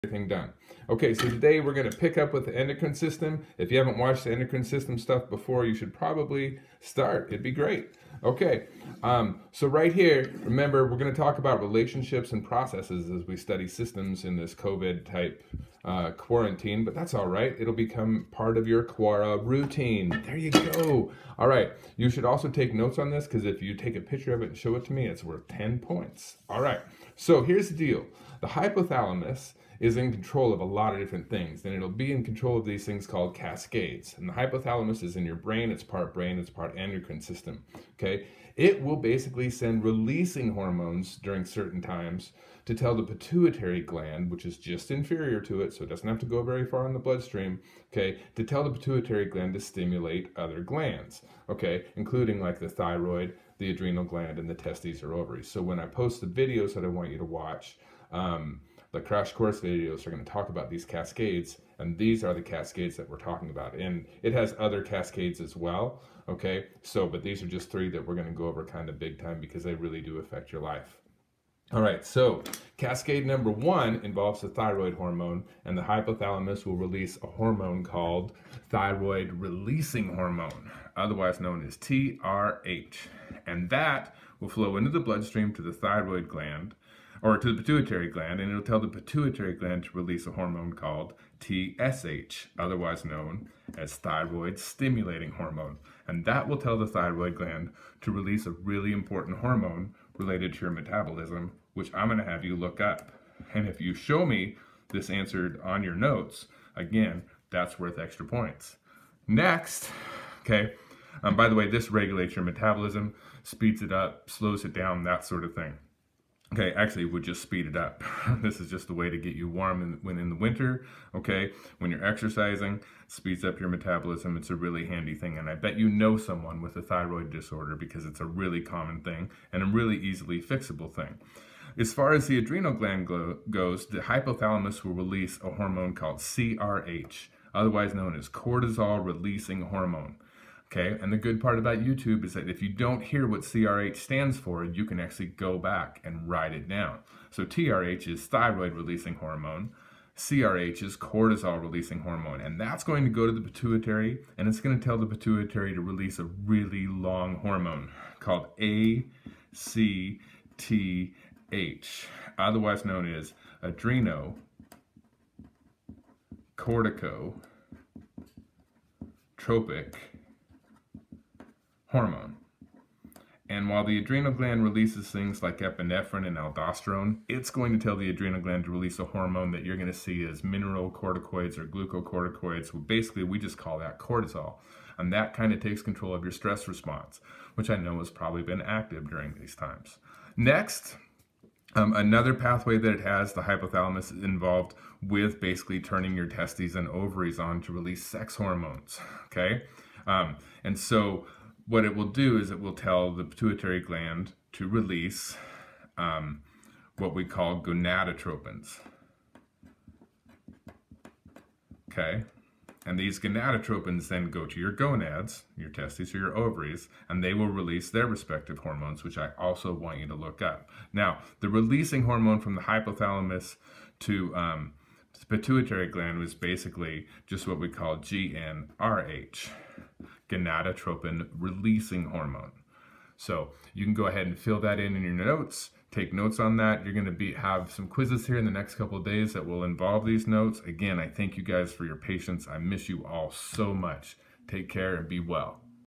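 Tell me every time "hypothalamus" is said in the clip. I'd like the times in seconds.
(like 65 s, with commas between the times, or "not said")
28 s, 34 s, 75 s, 133 s, 193 s, 222 s.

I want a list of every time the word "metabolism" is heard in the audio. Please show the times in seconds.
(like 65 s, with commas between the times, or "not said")
100 s, 112 s, 123 s.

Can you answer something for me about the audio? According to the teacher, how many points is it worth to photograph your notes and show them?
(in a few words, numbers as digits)
10.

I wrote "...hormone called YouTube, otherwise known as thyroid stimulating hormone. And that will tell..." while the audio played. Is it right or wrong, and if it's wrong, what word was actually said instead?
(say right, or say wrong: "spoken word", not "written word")
wrong: "TSH", not "YouTube".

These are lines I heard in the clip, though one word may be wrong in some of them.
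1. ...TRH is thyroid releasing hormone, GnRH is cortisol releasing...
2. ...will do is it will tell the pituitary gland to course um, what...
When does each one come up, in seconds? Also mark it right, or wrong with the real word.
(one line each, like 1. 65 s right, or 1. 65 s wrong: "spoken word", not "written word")
1. 147 s wrong: "CRH", not "GnRH"
2. 201 s wrong: "release", not "course".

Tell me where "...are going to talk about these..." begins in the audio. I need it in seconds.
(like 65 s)
60 s.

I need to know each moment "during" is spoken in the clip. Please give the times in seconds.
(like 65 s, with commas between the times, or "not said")
41 s, 189 s.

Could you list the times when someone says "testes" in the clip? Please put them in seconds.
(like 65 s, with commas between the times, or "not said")
54 s, 196 s, 215 s.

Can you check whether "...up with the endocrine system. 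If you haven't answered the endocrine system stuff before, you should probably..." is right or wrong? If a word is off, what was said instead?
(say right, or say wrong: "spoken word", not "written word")
wrong: "watched", not "answered".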